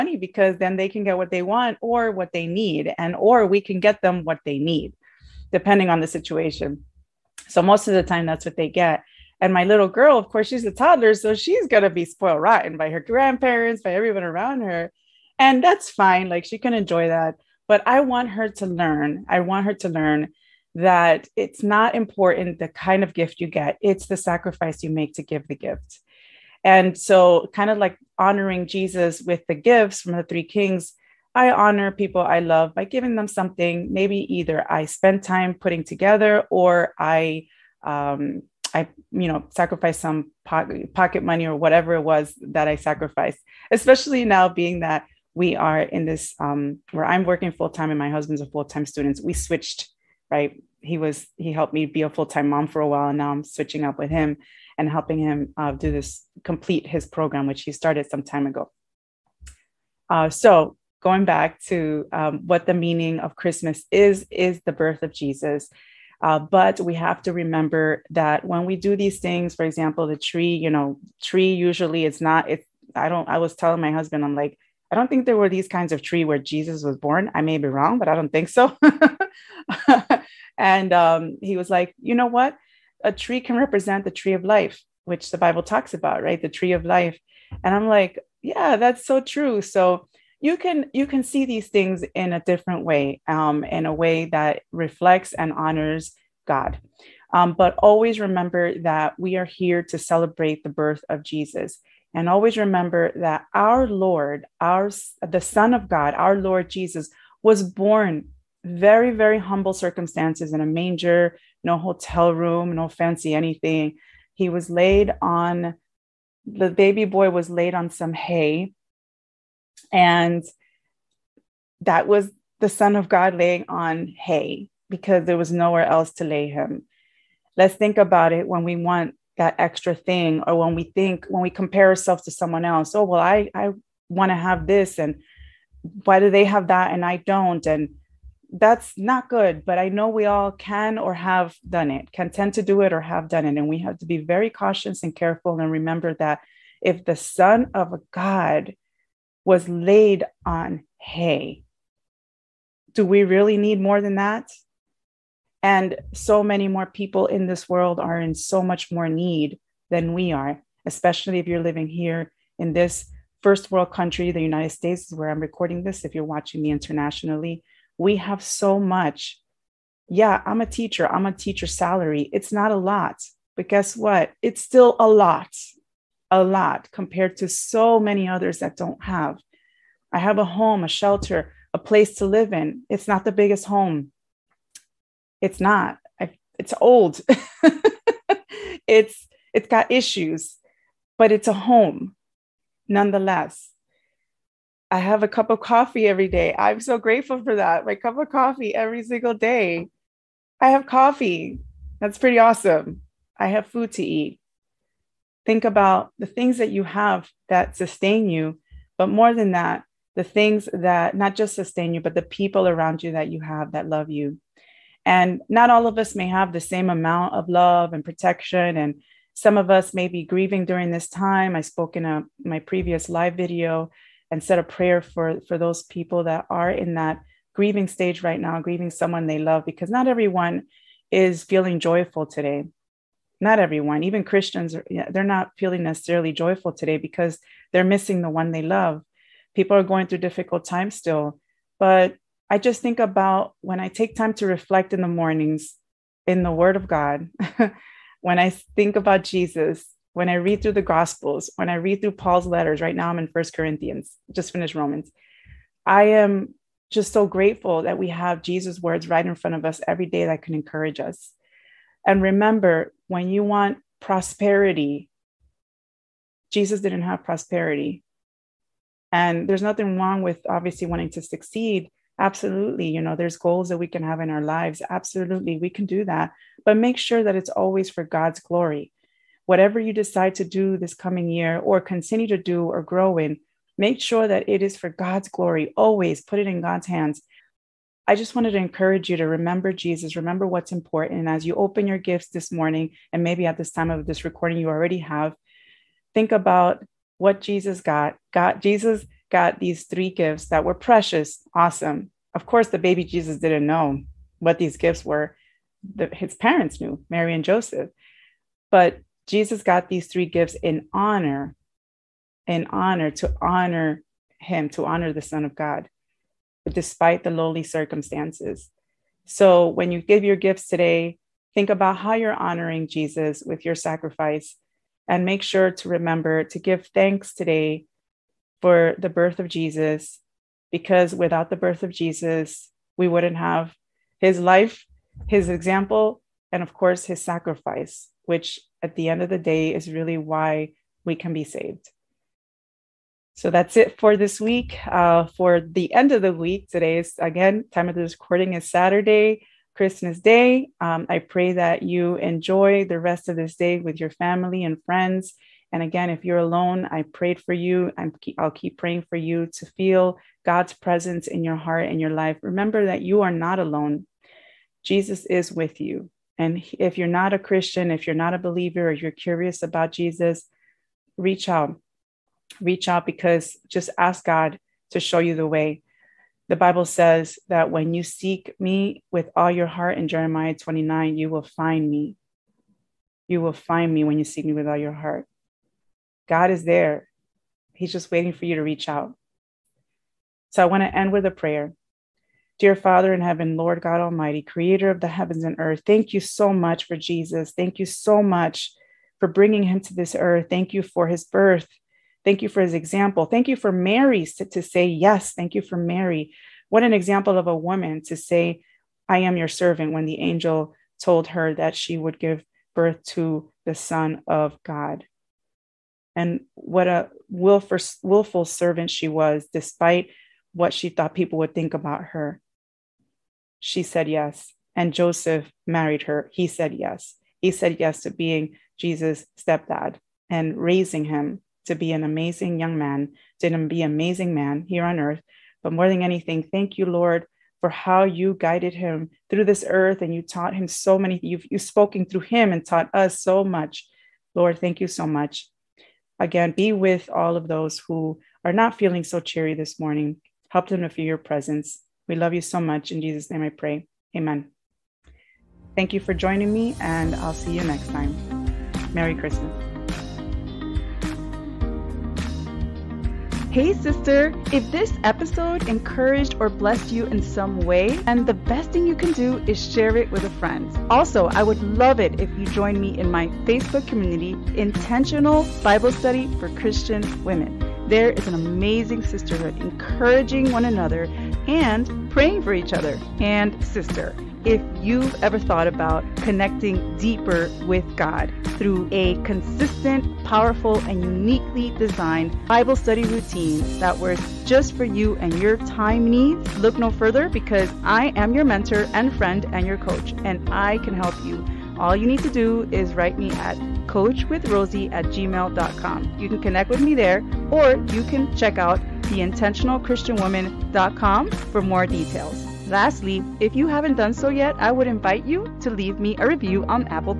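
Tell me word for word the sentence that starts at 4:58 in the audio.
Got Jesus got these three gifts that were precious, awesome.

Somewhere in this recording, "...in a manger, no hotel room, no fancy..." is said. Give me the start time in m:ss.
1:50.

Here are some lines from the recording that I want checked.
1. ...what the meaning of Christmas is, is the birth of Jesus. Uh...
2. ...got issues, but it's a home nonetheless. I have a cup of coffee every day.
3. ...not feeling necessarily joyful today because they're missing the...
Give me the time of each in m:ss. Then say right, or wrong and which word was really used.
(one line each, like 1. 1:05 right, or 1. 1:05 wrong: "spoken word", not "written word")
1. 1:02 right
2. 3:09 right
3. 3:55 right.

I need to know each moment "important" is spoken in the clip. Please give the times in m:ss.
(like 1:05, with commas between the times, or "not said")
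0:21, 4:50.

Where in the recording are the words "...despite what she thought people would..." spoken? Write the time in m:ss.
6:59.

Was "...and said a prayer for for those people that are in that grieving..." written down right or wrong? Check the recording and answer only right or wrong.
right.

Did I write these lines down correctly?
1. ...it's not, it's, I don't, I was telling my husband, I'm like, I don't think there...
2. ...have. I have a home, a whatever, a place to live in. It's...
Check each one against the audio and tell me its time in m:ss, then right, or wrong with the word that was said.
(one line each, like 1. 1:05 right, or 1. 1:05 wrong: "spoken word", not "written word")
1. 1:12 right
2. 2:59 wrong: "shelter", not "whatever".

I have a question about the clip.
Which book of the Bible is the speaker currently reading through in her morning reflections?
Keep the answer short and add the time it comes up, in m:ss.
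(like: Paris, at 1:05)
First Corinthians, at 4:13.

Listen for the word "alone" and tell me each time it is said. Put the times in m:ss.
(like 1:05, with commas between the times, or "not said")
5:56, 6:03.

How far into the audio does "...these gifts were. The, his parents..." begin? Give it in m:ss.
5:04.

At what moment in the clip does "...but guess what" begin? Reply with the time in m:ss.
2:53.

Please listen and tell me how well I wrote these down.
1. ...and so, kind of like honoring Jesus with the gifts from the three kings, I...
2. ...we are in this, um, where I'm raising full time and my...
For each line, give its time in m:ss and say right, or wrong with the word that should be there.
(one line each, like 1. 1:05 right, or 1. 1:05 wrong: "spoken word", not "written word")
1. 0:26 right
2. 0:45 wrong: "working", not "raising".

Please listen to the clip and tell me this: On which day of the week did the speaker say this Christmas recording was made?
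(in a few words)
Saturday.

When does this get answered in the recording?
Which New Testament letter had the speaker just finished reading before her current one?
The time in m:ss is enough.
4:14.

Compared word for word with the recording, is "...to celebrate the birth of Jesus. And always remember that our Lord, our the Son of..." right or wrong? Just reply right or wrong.
right.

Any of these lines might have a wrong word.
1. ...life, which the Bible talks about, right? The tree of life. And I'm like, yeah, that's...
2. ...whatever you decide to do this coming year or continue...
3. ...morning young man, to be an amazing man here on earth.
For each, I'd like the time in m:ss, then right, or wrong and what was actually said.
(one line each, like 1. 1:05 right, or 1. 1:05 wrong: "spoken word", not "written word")
1. 1:24 right
2. 4:39 right
3. 7:12 wrong: "amazing", not "morning".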